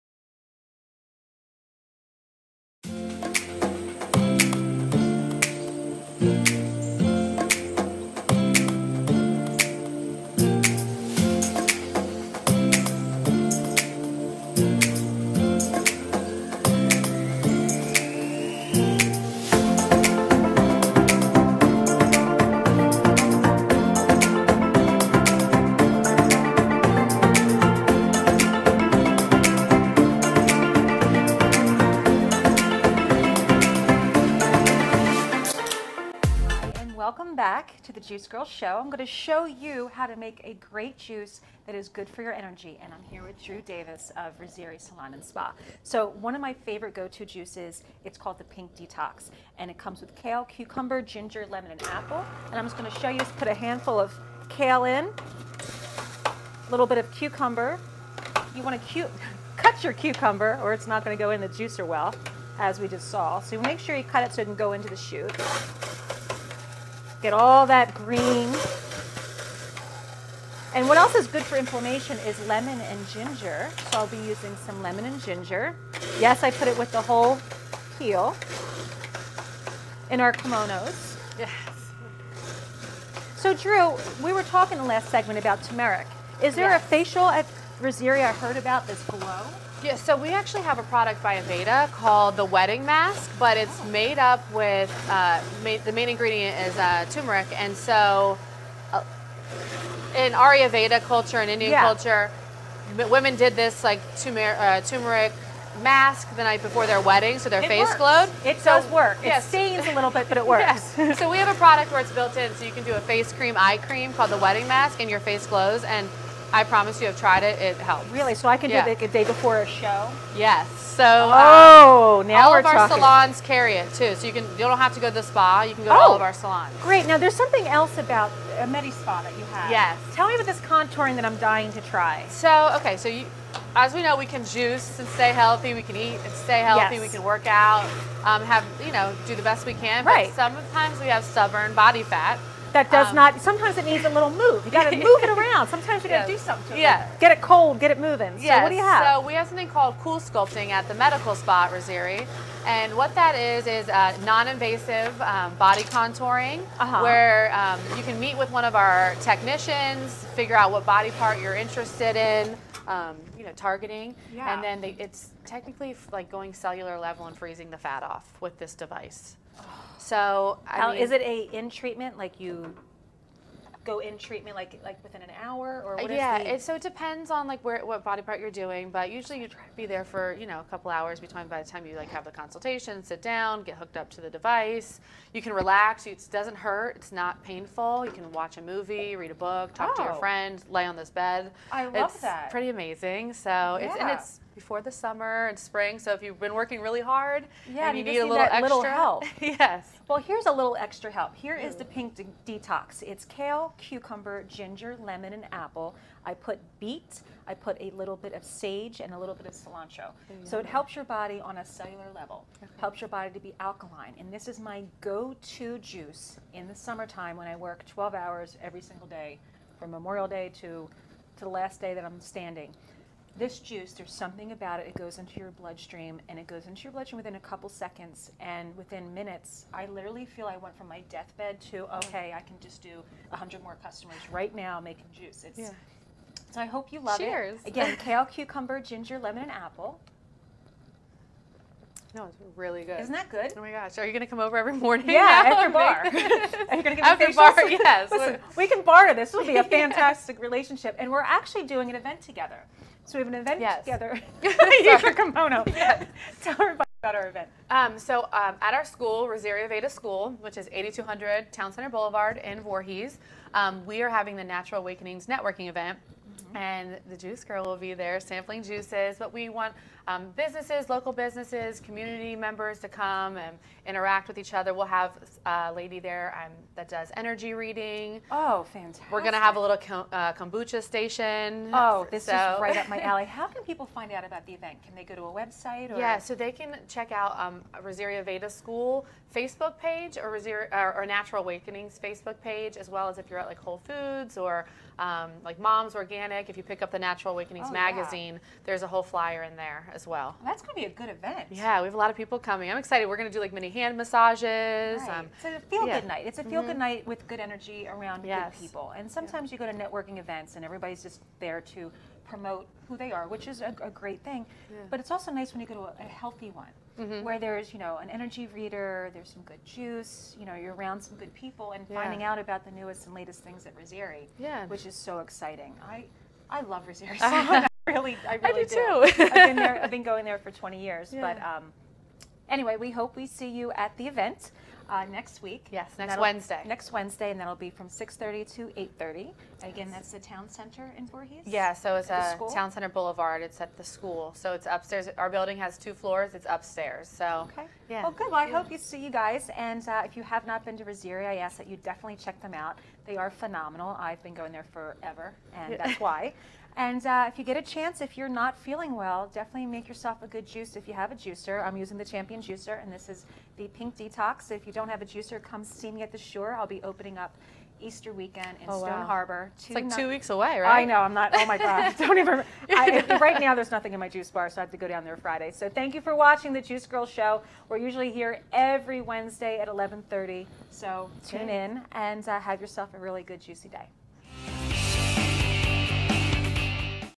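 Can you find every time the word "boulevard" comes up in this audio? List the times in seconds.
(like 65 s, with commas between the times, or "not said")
261 s, 342 s.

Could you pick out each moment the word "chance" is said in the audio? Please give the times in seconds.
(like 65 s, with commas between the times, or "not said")
357 s.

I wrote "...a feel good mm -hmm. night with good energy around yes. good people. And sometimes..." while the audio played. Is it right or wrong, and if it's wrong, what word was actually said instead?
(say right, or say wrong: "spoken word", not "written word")
right.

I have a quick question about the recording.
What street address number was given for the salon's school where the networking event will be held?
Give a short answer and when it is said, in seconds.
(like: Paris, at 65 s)
8200, at 260 s.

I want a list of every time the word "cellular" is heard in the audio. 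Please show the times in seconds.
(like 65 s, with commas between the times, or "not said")
166 s, 211 s.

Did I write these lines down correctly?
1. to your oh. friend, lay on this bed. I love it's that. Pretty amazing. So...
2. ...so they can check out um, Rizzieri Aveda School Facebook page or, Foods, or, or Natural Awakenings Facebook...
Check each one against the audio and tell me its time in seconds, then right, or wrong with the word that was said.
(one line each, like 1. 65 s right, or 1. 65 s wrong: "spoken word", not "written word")
1. 189 s right
2. 286 s wrong: "Rizzieri", not "Foods".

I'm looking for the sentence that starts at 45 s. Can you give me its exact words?
So one of my favorite go-to juices, it's called the Pink Detox.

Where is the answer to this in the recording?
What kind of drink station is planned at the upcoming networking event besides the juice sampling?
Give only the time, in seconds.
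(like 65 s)
280 s.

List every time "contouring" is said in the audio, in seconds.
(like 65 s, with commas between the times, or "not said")
130 s, 155 s.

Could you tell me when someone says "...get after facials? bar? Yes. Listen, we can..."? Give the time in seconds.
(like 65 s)
246 s.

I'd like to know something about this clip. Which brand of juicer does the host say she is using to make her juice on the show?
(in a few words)
Champion Juicer.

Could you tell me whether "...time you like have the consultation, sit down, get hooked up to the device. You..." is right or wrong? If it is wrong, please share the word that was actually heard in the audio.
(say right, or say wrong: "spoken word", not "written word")
right.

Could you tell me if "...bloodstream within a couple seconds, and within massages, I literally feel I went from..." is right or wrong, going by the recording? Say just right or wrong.
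wrong.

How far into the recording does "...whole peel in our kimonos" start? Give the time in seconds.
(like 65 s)
77 s.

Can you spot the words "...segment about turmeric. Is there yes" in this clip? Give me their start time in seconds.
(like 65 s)
85 s.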